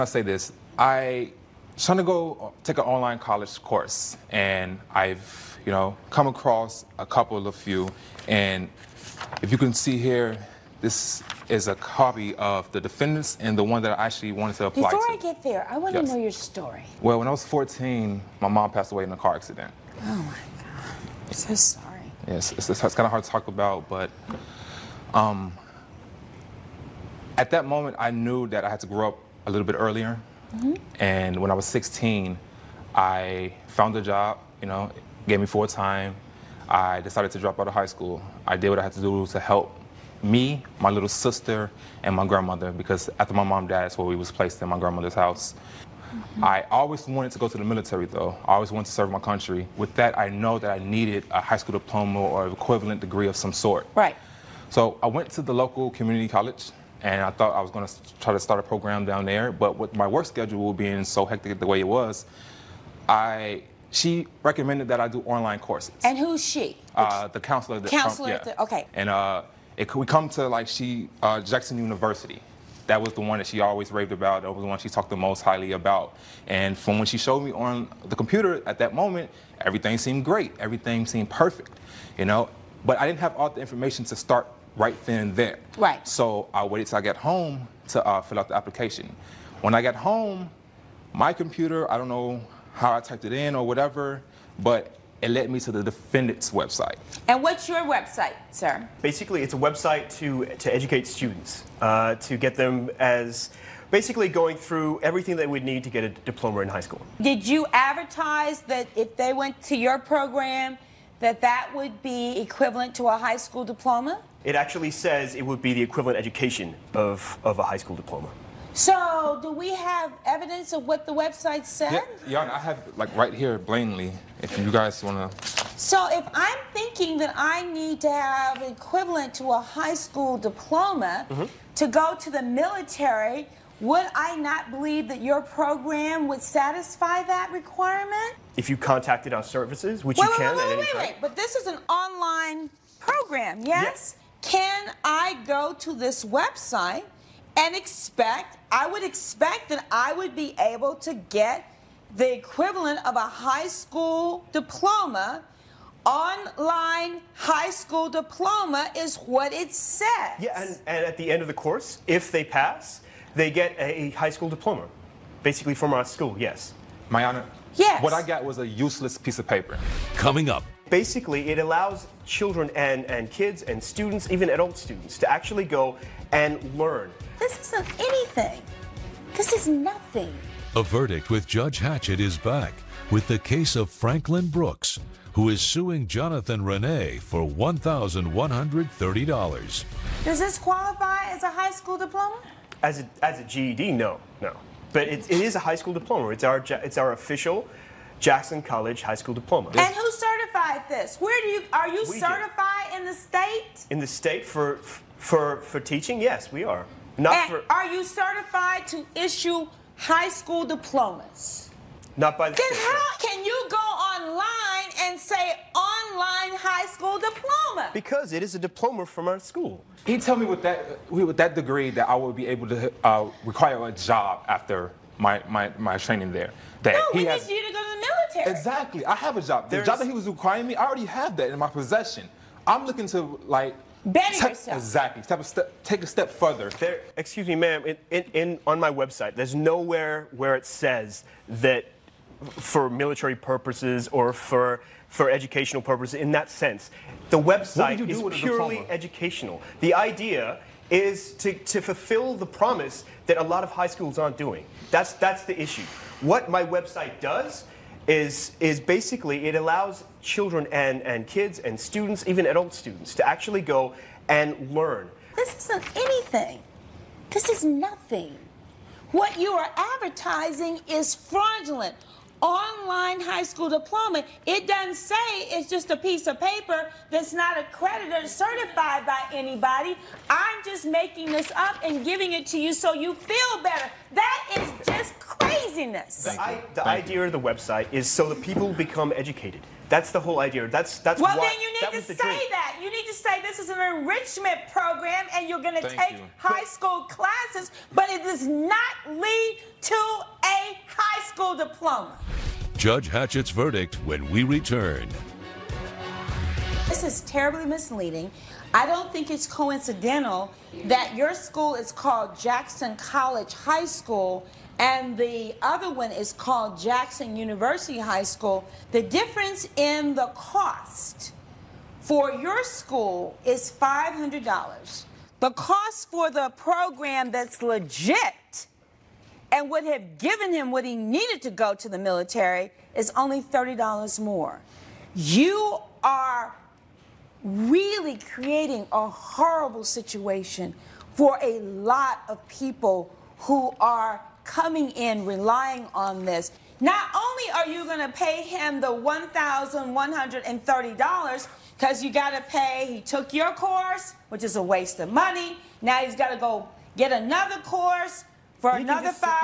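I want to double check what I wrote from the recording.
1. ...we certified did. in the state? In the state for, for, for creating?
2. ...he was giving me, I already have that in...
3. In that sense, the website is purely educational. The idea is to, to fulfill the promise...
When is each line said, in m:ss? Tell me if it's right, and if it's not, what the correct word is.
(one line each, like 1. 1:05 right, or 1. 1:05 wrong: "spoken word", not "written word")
1. 3:22 wrong: "teaching", not "creating"
2. 3:50 wrong: "requiring", not "giving"
3. 4:06 right.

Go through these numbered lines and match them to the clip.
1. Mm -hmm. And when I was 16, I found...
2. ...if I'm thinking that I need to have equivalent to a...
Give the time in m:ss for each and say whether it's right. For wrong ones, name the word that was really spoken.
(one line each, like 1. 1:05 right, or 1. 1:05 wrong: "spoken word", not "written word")
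1. 0:30 right
2. 2:06 right.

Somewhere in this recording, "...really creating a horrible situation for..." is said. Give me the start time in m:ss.
5:37.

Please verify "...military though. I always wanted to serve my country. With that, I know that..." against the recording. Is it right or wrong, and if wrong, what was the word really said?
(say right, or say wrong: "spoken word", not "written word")
right.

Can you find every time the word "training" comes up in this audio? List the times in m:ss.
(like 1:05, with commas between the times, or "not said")
3:45.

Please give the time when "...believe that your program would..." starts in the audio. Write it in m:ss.
2:14.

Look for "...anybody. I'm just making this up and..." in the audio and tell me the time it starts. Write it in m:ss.
4:39.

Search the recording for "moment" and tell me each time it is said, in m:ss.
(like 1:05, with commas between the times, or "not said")
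0:27, 1:18.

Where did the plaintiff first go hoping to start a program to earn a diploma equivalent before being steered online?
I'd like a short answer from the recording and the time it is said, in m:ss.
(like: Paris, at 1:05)
local community college, at 0:55.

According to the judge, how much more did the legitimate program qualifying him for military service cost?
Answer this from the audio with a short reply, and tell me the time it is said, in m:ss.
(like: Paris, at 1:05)
$30, at 5:33.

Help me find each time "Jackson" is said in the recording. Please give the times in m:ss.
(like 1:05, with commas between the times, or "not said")
1:11, 3:18, 5:12, 5:16.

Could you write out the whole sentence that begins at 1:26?
So I waited till I got home to uh, fill out the application.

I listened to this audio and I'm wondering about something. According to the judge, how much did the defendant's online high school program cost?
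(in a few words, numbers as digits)
$500.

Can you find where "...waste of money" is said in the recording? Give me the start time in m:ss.
5:54.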